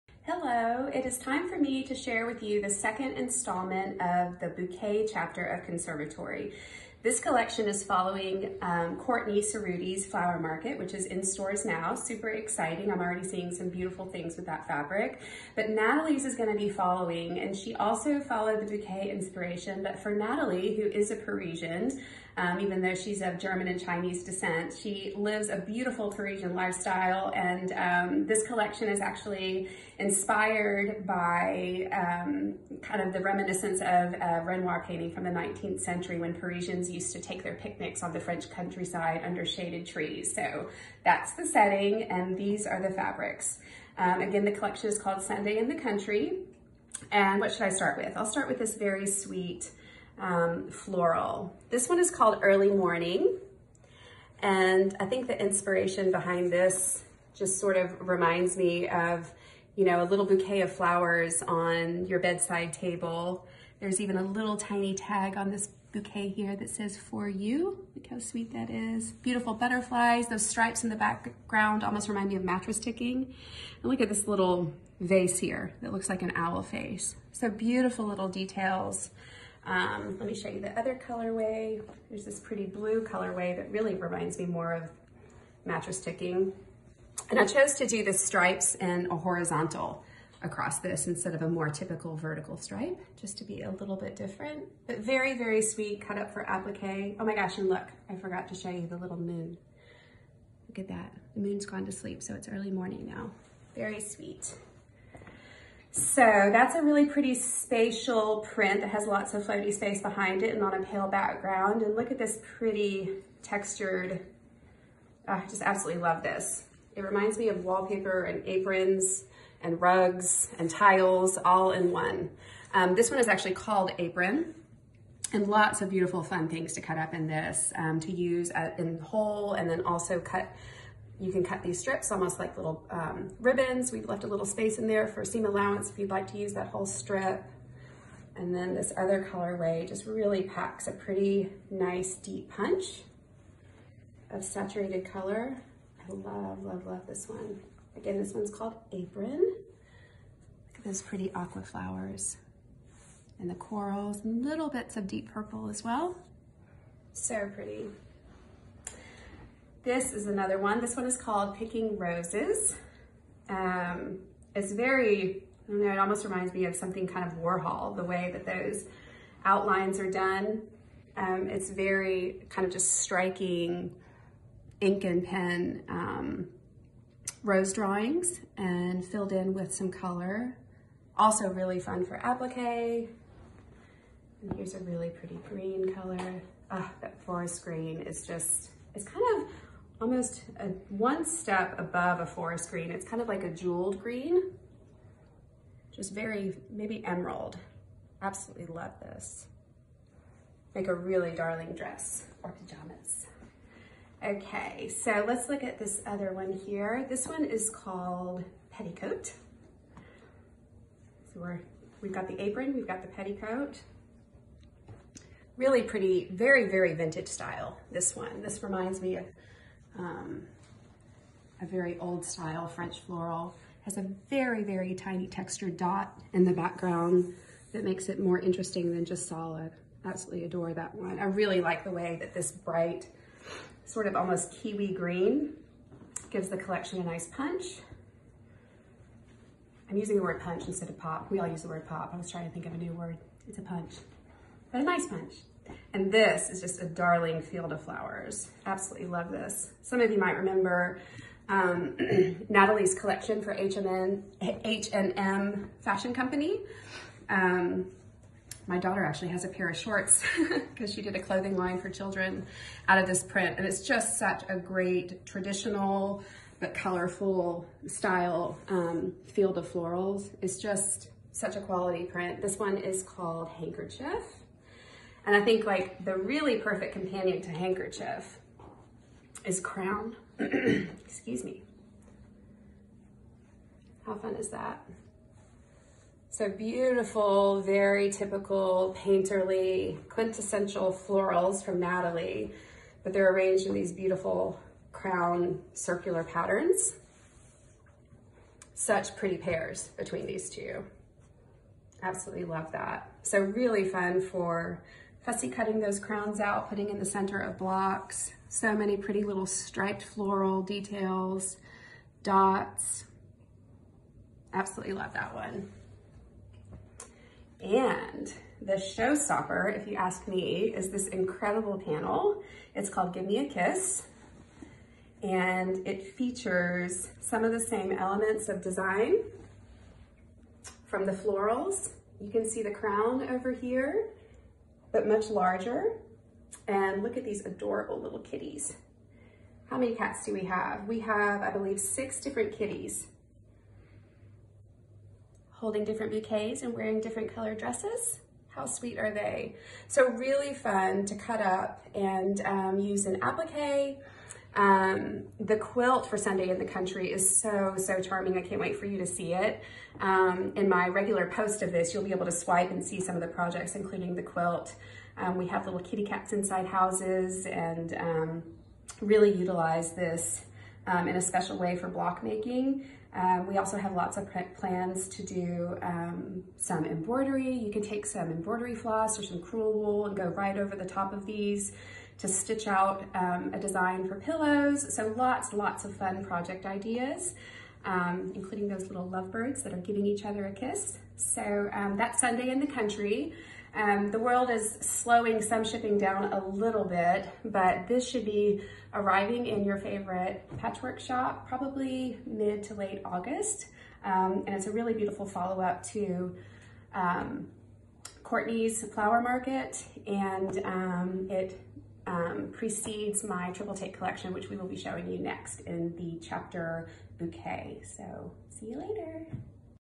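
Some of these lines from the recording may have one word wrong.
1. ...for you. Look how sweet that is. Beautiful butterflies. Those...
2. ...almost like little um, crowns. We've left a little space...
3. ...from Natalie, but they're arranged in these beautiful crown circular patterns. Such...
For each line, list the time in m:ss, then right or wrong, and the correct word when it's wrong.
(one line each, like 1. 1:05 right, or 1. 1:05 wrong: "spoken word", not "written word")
1. 1:06 right
2. 2:12 wrong: "ribbons", not "crowns"
3. 4:51 right.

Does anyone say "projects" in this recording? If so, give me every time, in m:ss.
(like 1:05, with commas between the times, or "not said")
6:03, 6:26.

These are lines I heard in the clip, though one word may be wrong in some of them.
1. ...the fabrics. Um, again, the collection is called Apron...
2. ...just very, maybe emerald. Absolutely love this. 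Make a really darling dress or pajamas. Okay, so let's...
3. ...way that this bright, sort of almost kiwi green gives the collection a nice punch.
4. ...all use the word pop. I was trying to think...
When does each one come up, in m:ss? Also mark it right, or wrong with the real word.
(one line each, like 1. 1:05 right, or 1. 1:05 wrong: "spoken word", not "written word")
1. 0:42 wrong: "Sunday", not "Apron"
2. 3:15 right
3. 3:51 right
4. 4:01 right.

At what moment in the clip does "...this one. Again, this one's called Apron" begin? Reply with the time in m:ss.
2:27.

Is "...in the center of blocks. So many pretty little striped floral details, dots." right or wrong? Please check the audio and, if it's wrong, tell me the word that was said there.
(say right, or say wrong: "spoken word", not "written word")
right.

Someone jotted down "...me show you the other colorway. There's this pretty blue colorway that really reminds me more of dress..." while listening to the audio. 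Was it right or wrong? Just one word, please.
wrong.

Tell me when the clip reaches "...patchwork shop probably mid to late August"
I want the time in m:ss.
6:40.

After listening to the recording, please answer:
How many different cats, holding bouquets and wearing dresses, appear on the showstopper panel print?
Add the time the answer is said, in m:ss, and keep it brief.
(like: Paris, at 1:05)
6, at 5:41.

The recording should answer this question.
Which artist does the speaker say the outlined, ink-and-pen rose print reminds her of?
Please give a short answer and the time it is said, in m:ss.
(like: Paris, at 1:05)
Warhol, at 2:47.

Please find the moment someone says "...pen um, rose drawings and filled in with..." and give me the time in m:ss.
2:55.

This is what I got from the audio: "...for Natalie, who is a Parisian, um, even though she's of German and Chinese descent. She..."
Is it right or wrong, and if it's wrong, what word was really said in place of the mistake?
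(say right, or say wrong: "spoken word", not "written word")
right.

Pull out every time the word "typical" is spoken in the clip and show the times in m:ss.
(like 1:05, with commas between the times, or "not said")
1:31, 4:48.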